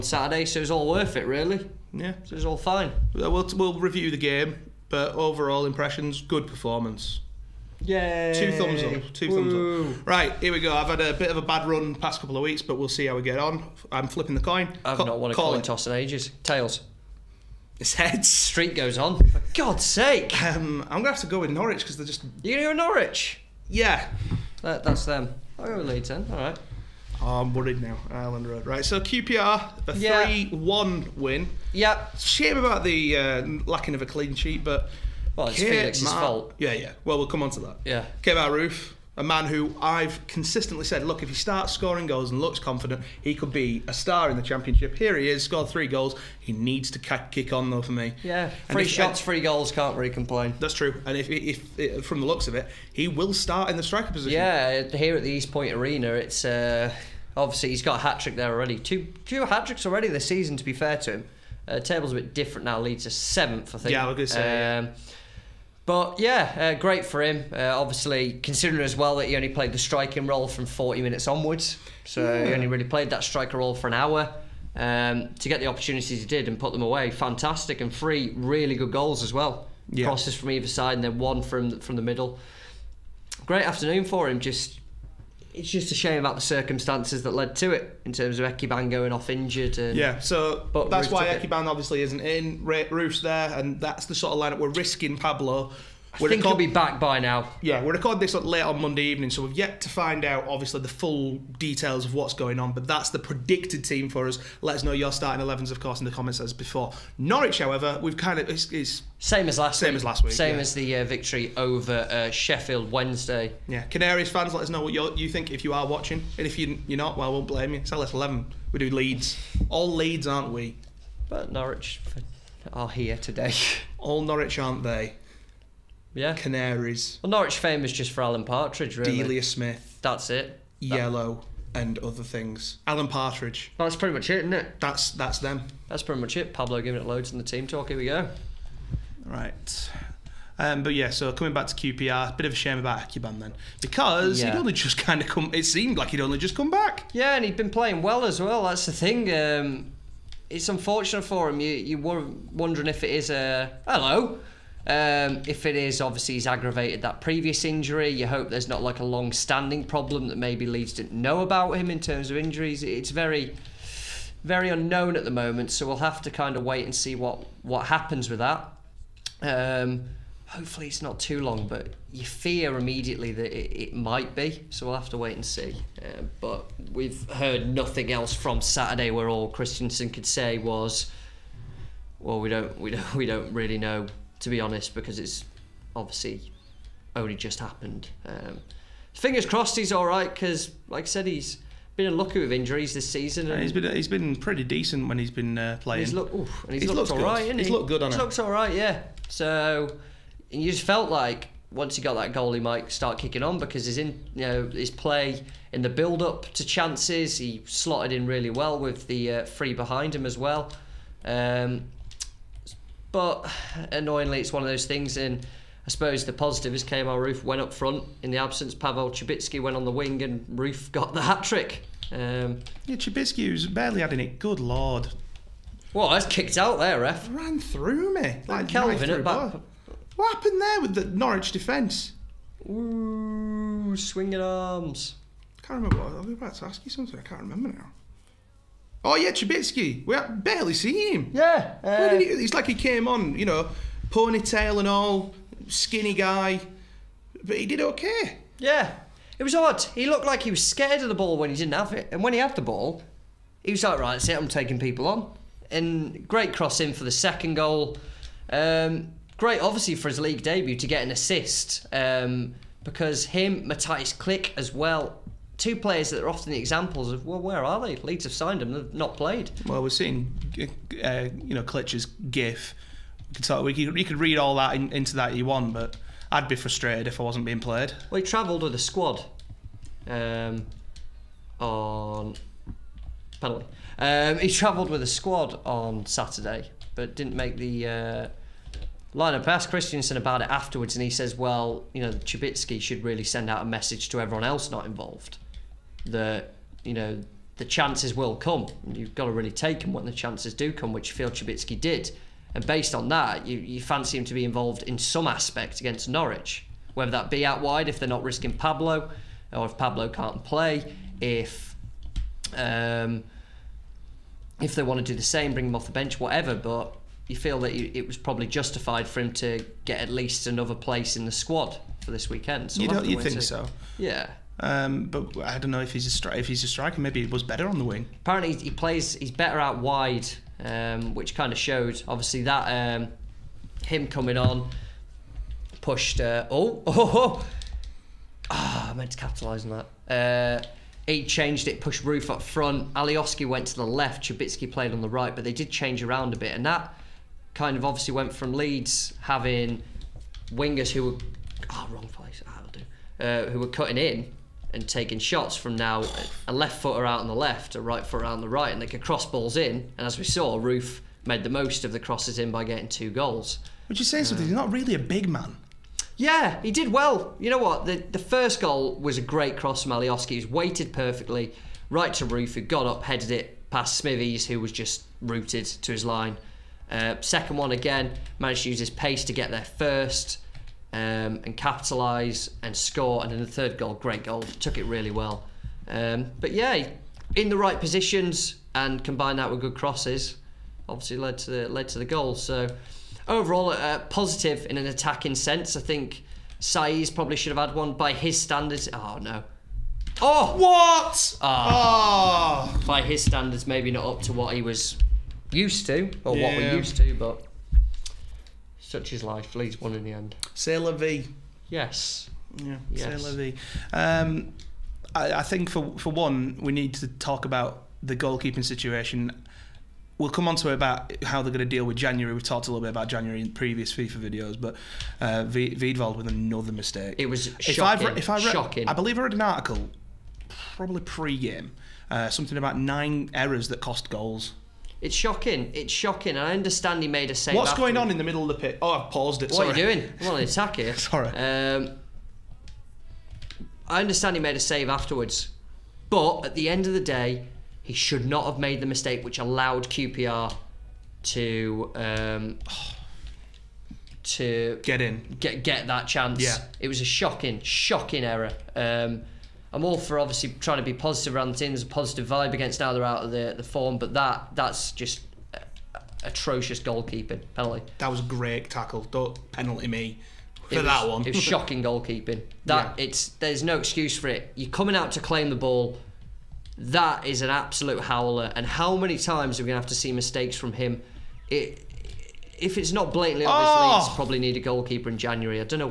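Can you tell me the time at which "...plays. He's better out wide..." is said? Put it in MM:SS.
05:28.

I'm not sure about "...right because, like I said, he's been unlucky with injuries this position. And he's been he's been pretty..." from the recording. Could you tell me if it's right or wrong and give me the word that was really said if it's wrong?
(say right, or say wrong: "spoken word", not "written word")
wrong: "season", not "position".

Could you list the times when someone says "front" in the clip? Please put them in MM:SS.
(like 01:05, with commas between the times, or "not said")
03:37, 05:42.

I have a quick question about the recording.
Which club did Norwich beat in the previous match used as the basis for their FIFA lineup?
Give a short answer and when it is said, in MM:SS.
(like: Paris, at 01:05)
Sheffield Wednesday, at 01:52.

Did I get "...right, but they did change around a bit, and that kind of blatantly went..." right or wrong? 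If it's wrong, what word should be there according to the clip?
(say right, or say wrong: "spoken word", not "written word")
wrong: "obviously", not "blatantly".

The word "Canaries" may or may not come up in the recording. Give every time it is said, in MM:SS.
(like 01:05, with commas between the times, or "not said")
01:53, 02:06.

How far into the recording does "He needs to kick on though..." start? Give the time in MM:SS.
00:46.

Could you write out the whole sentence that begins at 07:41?
There's a positive vibe against now they're out of the, the form, but that that's just atrocious goalkeeping penalty.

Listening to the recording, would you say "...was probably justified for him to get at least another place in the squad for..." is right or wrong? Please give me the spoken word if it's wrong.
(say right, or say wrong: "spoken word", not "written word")
right.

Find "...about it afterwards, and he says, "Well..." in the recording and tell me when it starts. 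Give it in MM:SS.
04:50.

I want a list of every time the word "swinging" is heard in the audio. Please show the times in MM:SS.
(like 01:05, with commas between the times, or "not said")
03:53.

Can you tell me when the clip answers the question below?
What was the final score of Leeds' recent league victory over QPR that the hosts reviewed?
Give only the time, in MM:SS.
00:30.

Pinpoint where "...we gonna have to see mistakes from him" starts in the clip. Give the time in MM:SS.
07:59.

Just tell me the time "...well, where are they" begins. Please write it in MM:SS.
04:27.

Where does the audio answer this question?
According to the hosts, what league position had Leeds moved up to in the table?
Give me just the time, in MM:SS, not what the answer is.
01:03.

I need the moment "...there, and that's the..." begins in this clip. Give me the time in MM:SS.
01:33.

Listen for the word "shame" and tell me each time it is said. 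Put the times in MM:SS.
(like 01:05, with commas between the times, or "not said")
00:32, 01:25, 02:22.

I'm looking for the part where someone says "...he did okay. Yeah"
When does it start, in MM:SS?
04:07.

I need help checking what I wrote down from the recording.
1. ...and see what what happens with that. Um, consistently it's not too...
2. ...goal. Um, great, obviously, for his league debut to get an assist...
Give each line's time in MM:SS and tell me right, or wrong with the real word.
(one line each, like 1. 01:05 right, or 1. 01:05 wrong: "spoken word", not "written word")
1. 02:46 wrong: "hopefully", not "consistently"
2. 04:17 right.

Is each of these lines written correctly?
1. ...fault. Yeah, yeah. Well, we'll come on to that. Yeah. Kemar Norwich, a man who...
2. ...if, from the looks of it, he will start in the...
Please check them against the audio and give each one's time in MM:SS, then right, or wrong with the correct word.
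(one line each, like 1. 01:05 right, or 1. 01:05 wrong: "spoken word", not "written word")
1. 00:36 wrong: "Roofe", not "Norwich"
2. 00:51 right.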